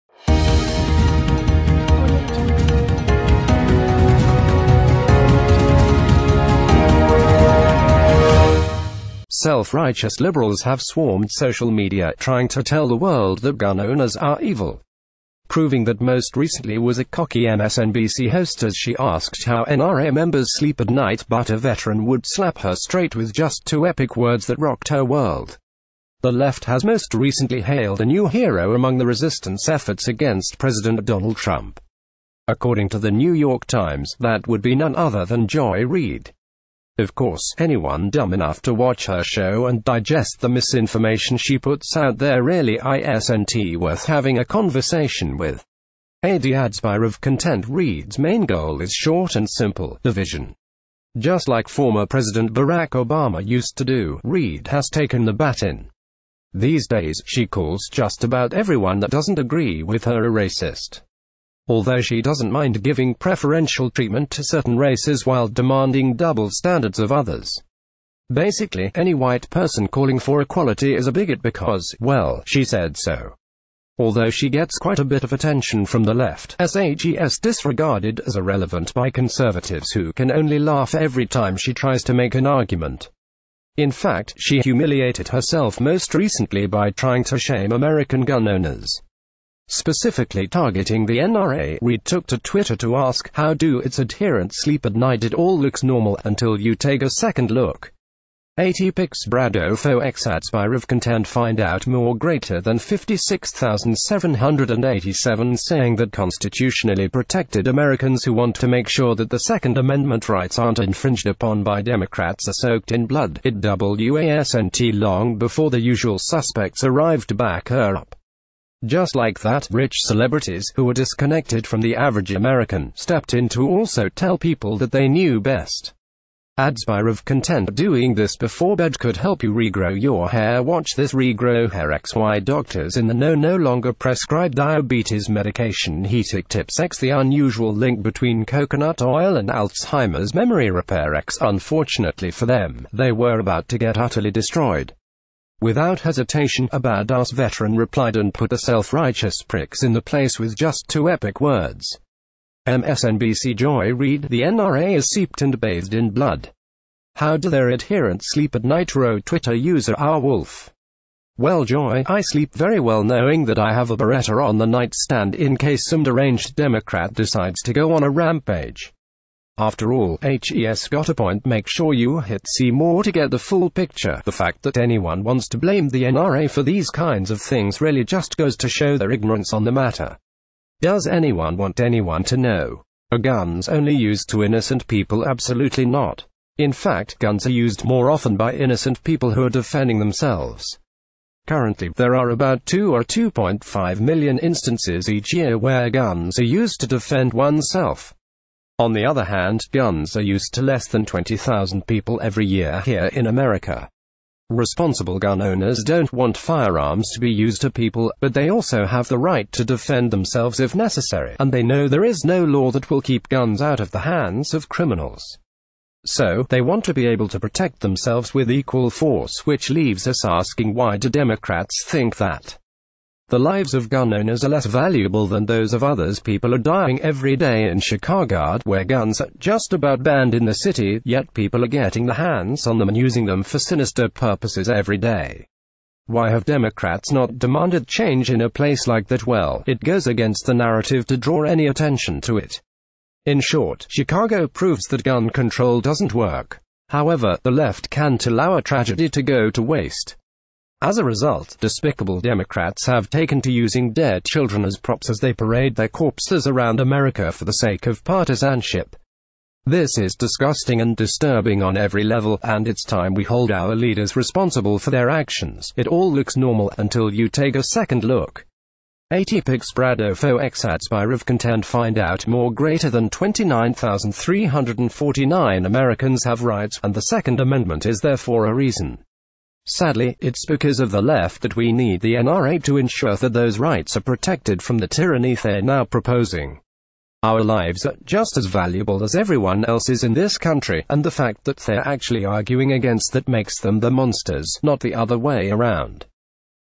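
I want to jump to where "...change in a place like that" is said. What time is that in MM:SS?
03:57.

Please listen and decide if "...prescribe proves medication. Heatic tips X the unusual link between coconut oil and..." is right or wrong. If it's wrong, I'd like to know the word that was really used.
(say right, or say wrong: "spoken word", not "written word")
wrong: "diabetes", not "proves".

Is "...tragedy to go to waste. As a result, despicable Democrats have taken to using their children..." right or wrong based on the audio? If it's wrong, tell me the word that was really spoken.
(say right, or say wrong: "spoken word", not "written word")
right.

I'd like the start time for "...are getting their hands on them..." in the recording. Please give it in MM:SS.
03:51.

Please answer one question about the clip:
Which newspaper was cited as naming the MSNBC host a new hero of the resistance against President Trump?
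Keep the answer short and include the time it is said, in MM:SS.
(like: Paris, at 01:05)
New York Times, at 00:33.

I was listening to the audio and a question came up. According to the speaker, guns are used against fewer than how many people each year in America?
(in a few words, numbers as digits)
20,000.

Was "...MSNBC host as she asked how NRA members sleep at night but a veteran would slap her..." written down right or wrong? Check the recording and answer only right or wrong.
right.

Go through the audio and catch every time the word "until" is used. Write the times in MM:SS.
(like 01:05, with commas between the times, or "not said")
01:36, 04:26.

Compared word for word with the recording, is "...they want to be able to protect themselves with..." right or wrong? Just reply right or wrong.
right.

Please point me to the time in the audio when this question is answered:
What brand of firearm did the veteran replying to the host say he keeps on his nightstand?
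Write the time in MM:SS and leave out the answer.
02:43.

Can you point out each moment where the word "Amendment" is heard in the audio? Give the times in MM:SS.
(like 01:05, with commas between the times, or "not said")
01:49, 04:37.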